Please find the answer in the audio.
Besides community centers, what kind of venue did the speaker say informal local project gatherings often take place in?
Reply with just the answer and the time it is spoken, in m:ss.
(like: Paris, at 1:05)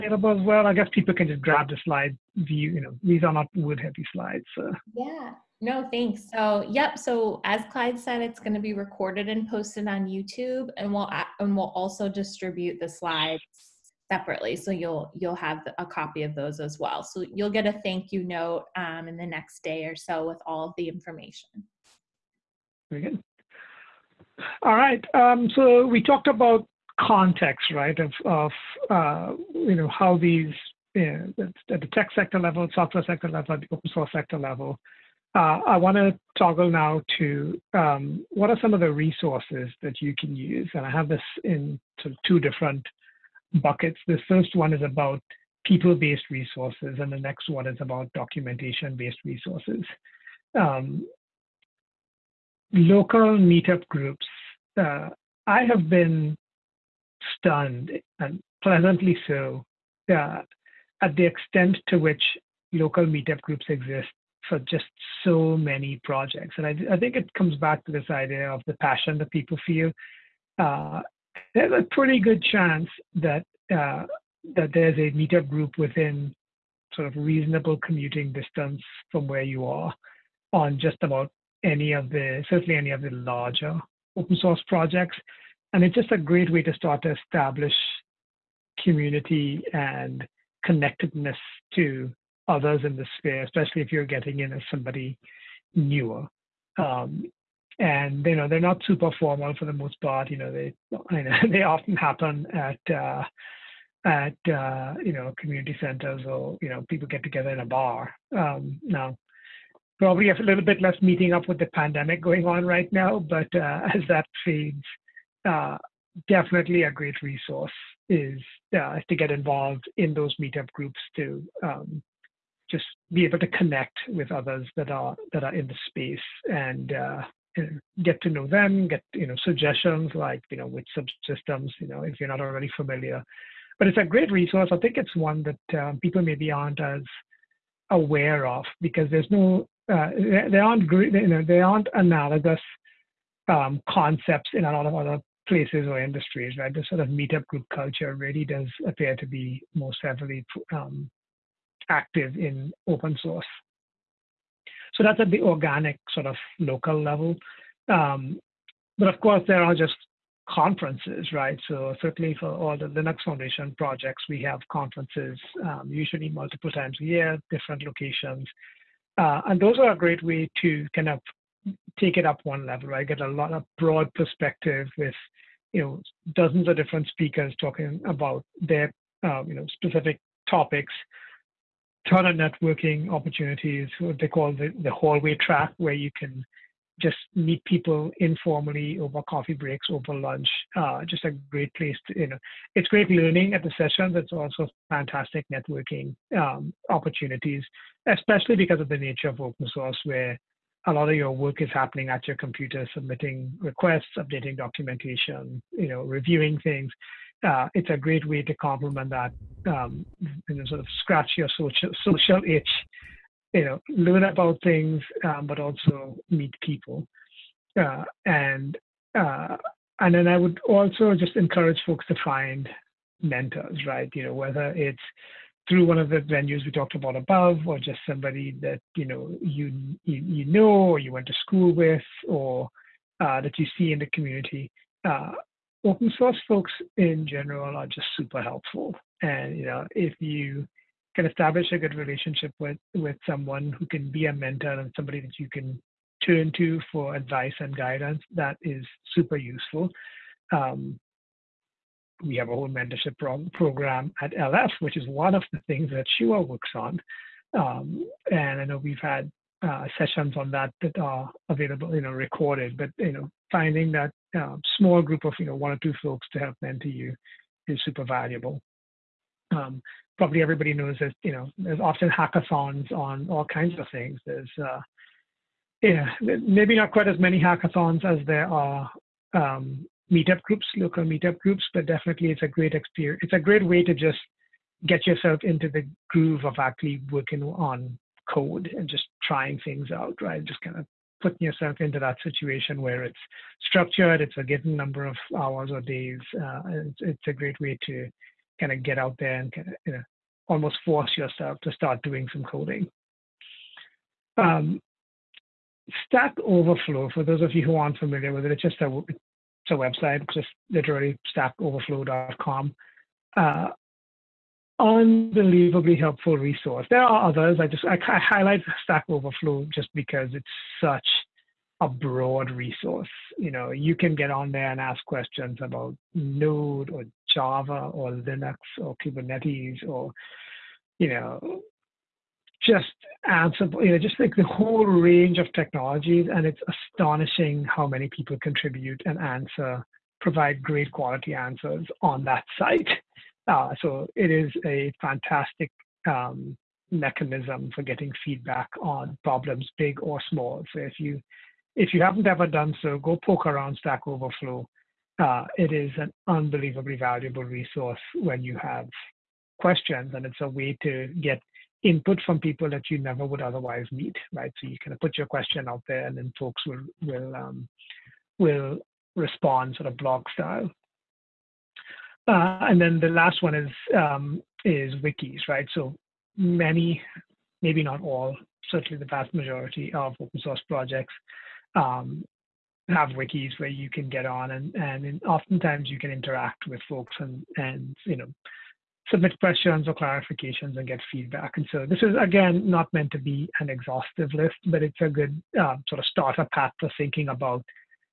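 a bar, at 1:47.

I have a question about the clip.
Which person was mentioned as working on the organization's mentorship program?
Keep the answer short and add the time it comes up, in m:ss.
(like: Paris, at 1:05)
Shuah, at 4:16.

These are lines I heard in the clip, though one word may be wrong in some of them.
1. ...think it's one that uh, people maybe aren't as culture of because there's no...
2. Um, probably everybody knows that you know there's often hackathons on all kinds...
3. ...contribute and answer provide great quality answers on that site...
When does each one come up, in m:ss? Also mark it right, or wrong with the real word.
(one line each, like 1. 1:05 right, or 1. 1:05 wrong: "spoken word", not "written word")
1. 2:14 wrong: "aware", not "culture"
2. 4:29 right
3. 5:38 right.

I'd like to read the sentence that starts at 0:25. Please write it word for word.
Um, so we talked about context, right?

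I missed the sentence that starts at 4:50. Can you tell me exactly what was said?
Just kind of putting yourself into that situation where it's structured, it's a given number of hours or days.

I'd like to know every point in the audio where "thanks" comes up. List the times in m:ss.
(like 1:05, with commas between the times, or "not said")
0:05, 0:17.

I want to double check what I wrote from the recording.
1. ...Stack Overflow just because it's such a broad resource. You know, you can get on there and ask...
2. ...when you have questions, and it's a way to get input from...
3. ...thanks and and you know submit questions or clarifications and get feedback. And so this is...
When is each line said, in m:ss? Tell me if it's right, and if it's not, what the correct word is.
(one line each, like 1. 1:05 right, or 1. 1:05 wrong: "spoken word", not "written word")
1. 5:18 right
2. 5:58 right
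3. 6:26 wrong: "folks", not "thanks".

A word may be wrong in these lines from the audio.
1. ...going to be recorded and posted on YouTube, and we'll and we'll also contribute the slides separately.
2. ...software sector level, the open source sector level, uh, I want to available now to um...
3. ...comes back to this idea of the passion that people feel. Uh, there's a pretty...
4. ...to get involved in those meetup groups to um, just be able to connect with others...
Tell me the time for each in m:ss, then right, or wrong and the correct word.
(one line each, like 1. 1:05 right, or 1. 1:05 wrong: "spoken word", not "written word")
1. 0:08 wrong: "distribute", not "contribute"
2. 0:32 wrong: "toggle", not "available"
3. 1:07 right
4. 1:59 right.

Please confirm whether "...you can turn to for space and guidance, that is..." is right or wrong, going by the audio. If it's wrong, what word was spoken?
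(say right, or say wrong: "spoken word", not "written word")
wrong: "advice", not "space".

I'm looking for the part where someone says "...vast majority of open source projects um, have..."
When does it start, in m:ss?
6:19.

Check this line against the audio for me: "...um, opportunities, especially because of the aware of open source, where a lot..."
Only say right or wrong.
wrong.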